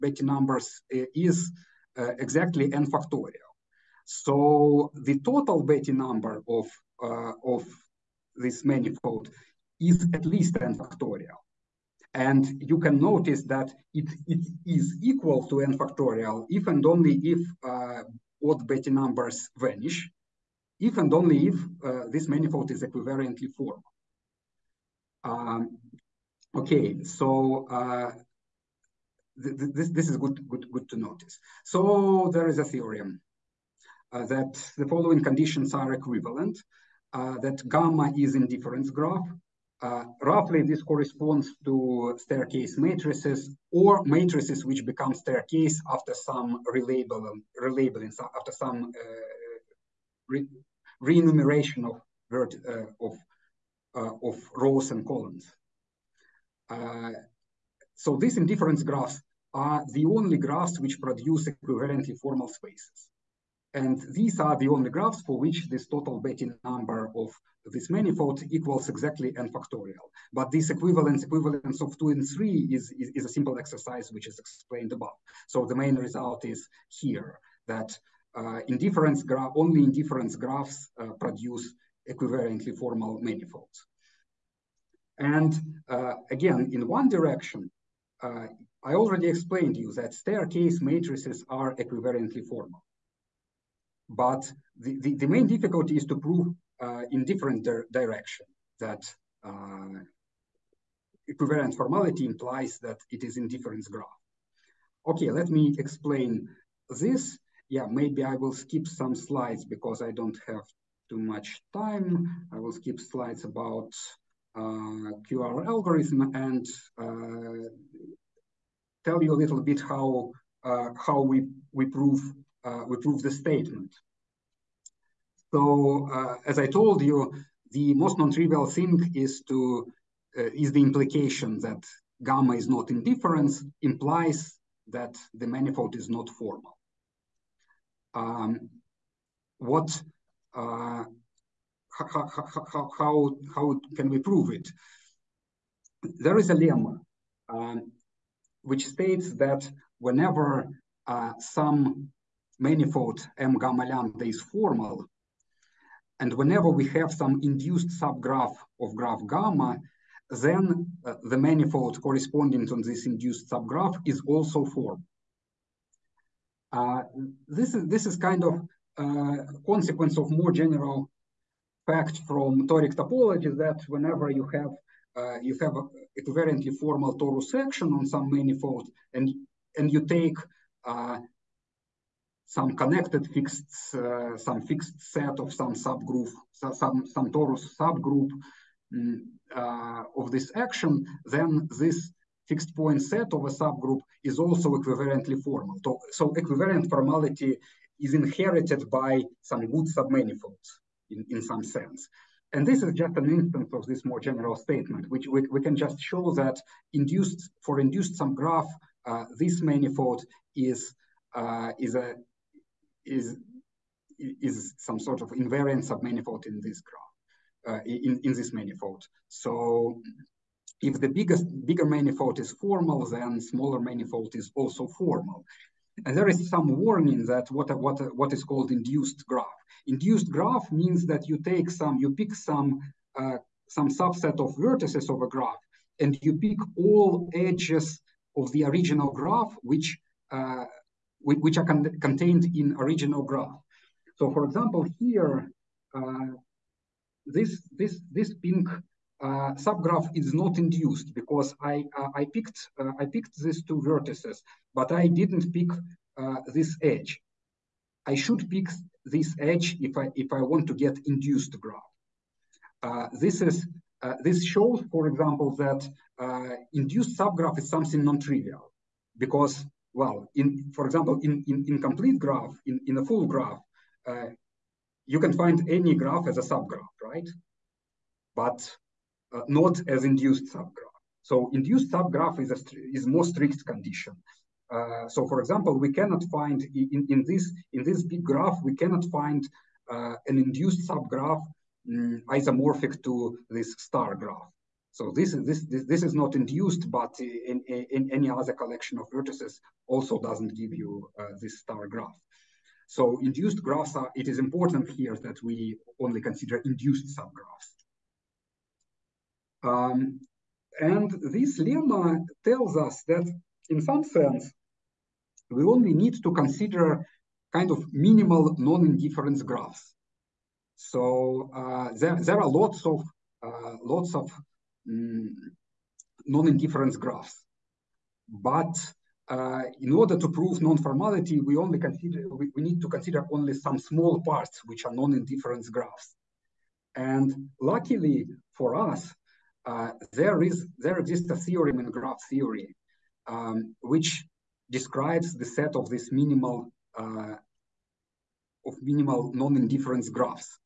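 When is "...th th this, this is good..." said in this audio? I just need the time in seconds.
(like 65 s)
29 s.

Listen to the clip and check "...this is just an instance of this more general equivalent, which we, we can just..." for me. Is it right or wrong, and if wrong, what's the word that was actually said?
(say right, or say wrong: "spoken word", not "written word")
wrong: "statement", not "equivalent".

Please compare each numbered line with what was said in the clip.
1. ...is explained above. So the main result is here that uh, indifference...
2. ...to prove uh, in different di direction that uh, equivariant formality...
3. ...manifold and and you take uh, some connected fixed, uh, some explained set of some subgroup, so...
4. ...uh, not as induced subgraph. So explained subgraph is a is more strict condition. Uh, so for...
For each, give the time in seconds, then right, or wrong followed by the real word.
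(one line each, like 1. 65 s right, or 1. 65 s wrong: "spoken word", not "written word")
1. 74 s right
2. 96 s right
3. 178 s wrong: "fixed", not "explained"
4. 279 s wrong: "induced", not "explained".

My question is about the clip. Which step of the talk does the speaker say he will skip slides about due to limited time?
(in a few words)
QR algorithm.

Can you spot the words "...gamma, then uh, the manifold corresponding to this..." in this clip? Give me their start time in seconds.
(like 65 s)
159 s.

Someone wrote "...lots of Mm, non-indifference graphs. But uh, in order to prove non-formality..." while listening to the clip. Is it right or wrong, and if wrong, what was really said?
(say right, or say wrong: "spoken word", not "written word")
right.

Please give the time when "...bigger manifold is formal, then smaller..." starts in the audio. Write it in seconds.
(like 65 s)
221 s.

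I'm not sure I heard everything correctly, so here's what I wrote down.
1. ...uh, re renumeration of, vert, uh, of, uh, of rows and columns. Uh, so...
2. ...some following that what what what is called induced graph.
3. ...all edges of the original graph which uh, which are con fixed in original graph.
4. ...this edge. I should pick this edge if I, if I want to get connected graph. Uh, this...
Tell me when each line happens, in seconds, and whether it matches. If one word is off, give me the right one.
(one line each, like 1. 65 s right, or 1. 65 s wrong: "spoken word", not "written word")
1. 48 s right
2. 226 s wrong: "warning", not "following"
3. 236 s wrong: "contained", not "fixed"
4. 256 s wrong: "induced", not "connected".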